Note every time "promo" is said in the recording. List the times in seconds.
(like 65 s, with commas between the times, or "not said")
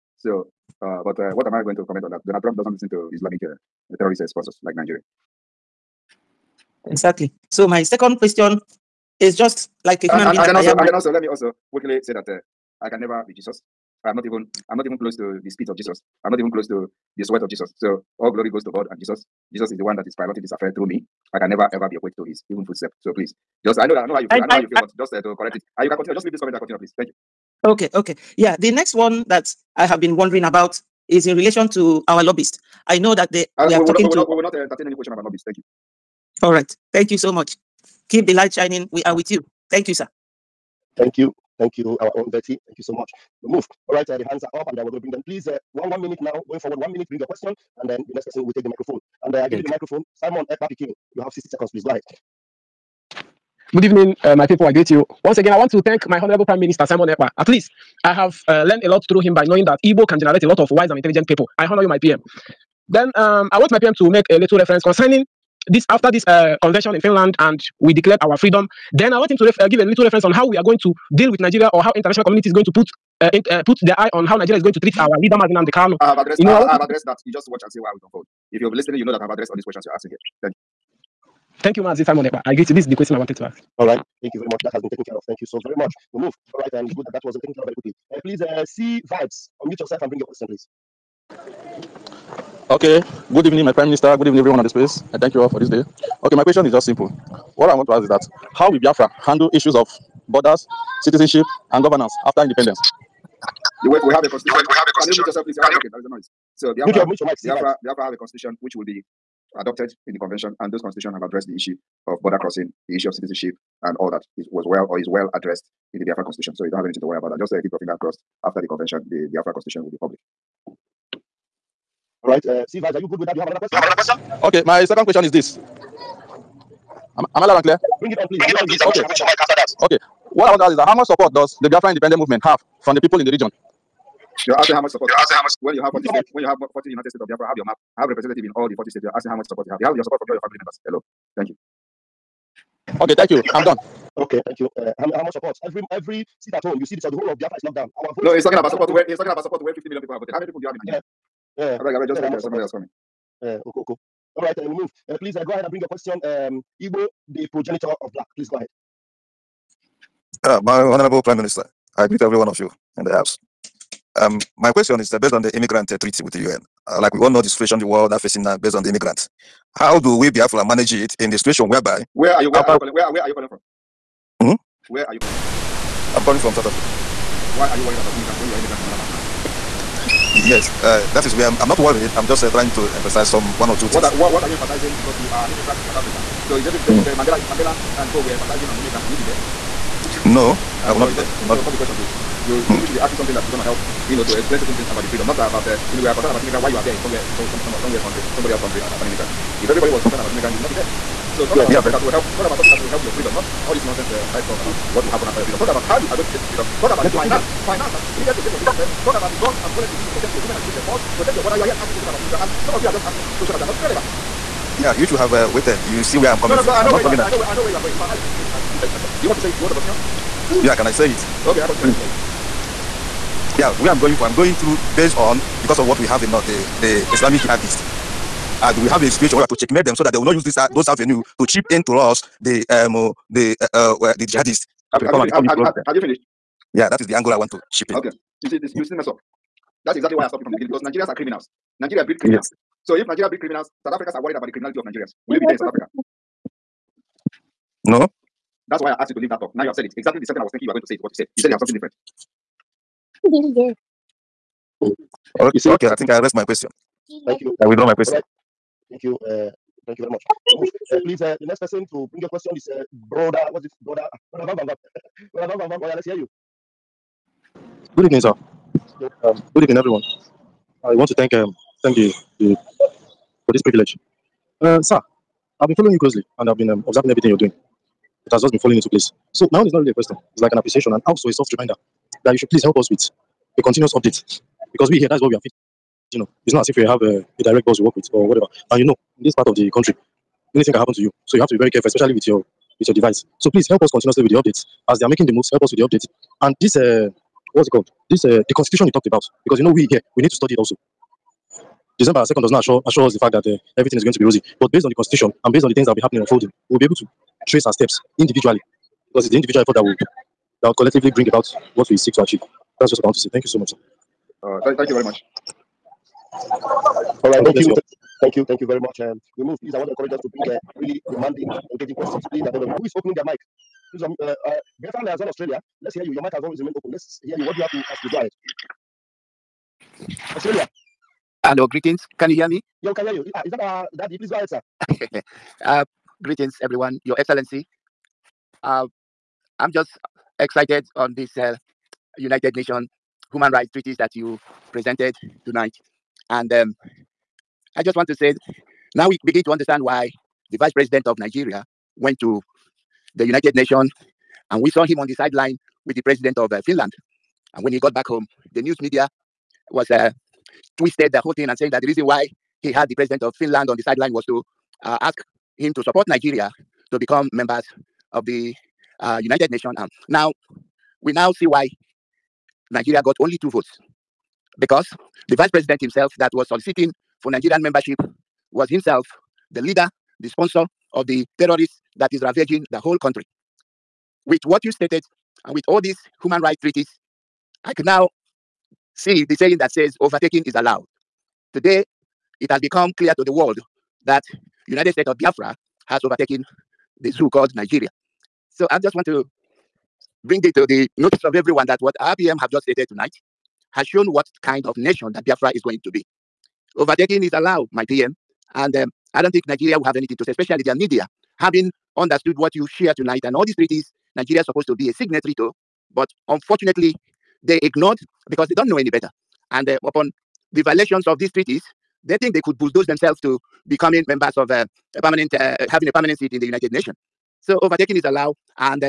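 not said.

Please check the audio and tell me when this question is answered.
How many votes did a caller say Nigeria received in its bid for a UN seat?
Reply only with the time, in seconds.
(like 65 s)
373 s.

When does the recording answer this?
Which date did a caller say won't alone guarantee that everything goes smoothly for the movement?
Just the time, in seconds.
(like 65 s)
301 s.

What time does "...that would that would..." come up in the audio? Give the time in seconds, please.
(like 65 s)
309 s.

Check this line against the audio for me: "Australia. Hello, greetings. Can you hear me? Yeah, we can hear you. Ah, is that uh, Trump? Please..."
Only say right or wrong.
wrong.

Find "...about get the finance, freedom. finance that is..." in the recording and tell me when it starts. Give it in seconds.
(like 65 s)
206 s.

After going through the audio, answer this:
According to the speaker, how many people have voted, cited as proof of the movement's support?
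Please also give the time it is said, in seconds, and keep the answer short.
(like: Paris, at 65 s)
50 million, at 149 s.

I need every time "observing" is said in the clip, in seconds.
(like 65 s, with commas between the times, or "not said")
276 s.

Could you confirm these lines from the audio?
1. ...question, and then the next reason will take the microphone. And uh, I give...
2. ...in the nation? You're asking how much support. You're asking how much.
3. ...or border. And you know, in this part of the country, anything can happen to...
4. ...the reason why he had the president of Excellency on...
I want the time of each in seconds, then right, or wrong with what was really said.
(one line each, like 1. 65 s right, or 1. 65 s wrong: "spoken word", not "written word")
1. 47 s wrong: "person", not "reason"
2. 133 s wrong: "region", not "nation"
3. 288 s wrong: "whatever", not "border"
4. 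361 s wrong: "Finland", not "Excellency".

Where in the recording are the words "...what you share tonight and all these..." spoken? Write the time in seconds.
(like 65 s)
412 s.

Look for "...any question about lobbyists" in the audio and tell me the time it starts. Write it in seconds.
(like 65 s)
34 s.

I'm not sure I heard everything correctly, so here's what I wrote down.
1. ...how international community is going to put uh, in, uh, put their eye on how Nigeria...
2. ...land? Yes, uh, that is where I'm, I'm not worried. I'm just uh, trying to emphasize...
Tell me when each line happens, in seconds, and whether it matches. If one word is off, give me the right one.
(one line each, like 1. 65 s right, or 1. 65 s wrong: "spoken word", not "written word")
1. 71 s right
2. 179 s right.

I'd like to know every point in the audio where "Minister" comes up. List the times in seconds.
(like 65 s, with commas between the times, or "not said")
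56 s, 93 s, 161 s.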